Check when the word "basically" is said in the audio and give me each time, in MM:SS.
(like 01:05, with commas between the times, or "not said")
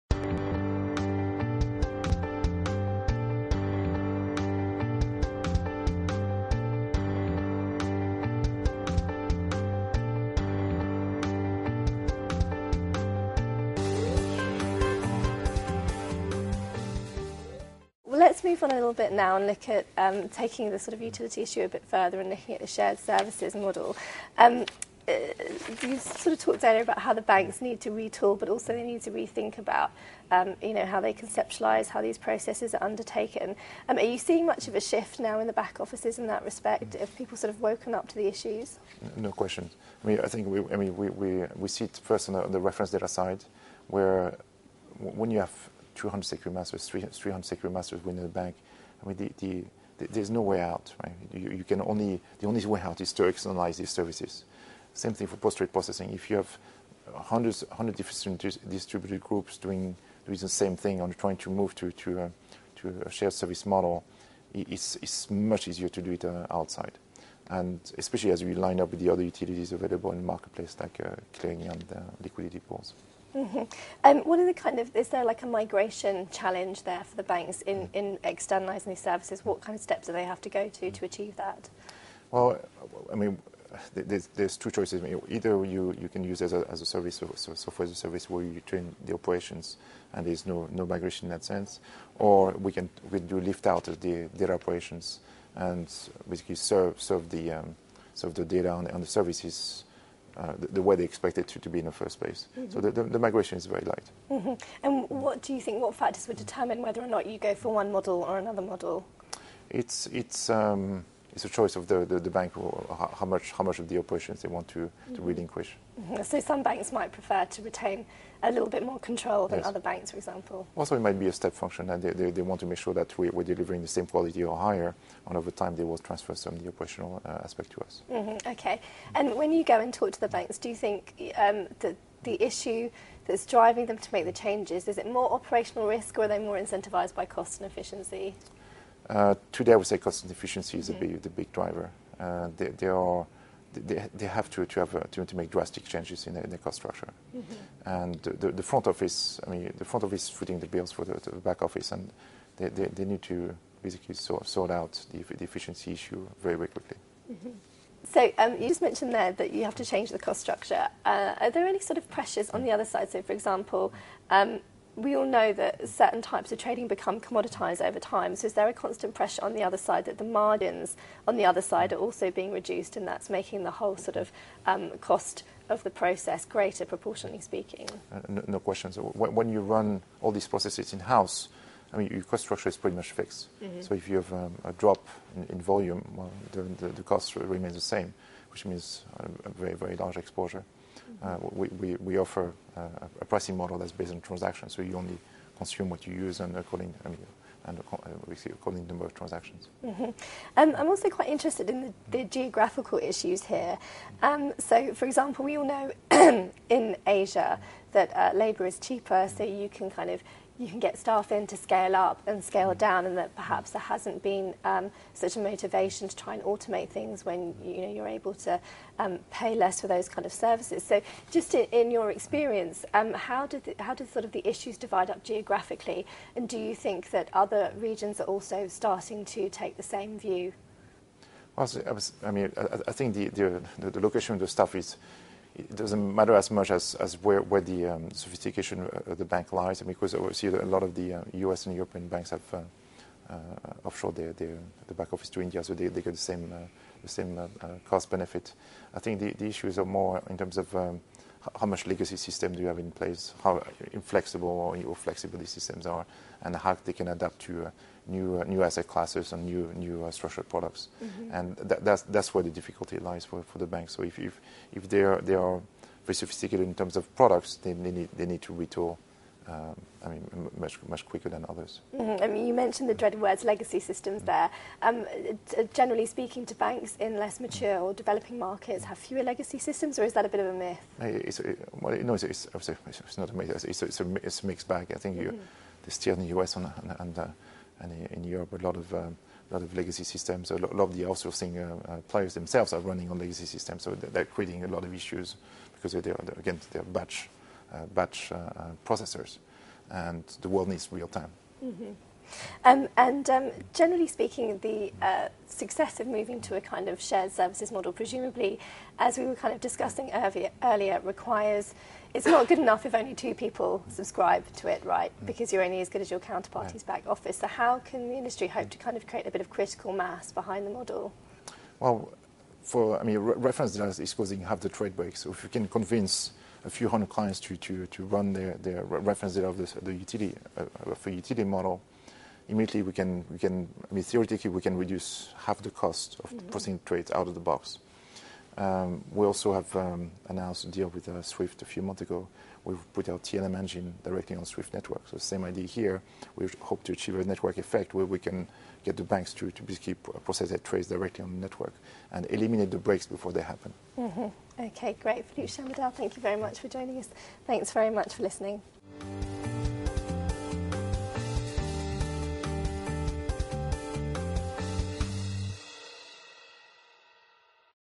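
01:36, 02:33, 05:49.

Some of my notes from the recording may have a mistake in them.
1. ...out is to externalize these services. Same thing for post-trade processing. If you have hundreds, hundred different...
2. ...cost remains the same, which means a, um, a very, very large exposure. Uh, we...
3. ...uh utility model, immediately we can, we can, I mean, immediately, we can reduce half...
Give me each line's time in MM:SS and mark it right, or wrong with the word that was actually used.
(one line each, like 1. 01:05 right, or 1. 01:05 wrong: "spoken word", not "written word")
1. 00:52 right
2. 03:07 right
3. 05:30 wrong: "theoretically", not "immediately".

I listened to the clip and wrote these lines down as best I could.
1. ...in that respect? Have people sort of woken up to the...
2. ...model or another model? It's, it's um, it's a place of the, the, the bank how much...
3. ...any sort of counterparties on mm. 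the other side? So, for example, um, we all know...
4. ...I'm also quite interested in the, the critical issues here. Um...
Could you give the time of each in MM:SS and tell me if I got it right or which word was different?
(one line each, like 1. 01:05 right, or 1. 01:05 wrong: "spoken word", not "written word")
1. 00:36 right
2. 01:47 wrong: "choice", not "place"
3. 02:41 wrong: "pressures", not "counterparties"
4. 03:20 wrong: "geographical", not "critical".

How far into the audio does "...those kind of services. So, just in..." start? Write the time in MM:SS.
03:39.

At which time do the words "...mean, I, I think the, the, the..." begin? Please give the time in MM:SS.
03:52.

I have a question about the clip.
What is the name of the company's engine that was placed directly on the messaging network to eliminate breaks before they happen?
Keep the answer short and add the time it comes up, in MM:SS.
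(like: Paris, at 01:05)
TLM, at 05:43.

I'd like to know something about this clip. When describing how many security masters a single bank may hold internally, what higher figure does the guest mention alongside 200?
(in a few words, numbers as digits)
300.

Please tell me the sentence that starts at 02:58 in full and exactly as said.
Uh, no, no when you run all these processes in house, I mean, your cost structure is pretty much fixed.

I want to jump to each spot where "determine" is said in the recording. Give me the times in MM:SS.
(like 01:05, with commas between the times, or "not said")
01:46.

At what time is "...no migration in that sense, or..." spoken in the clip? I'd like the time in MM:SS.
01:30.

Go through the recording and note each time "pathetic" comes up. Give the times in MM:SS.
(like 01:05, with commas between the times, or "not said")
not said.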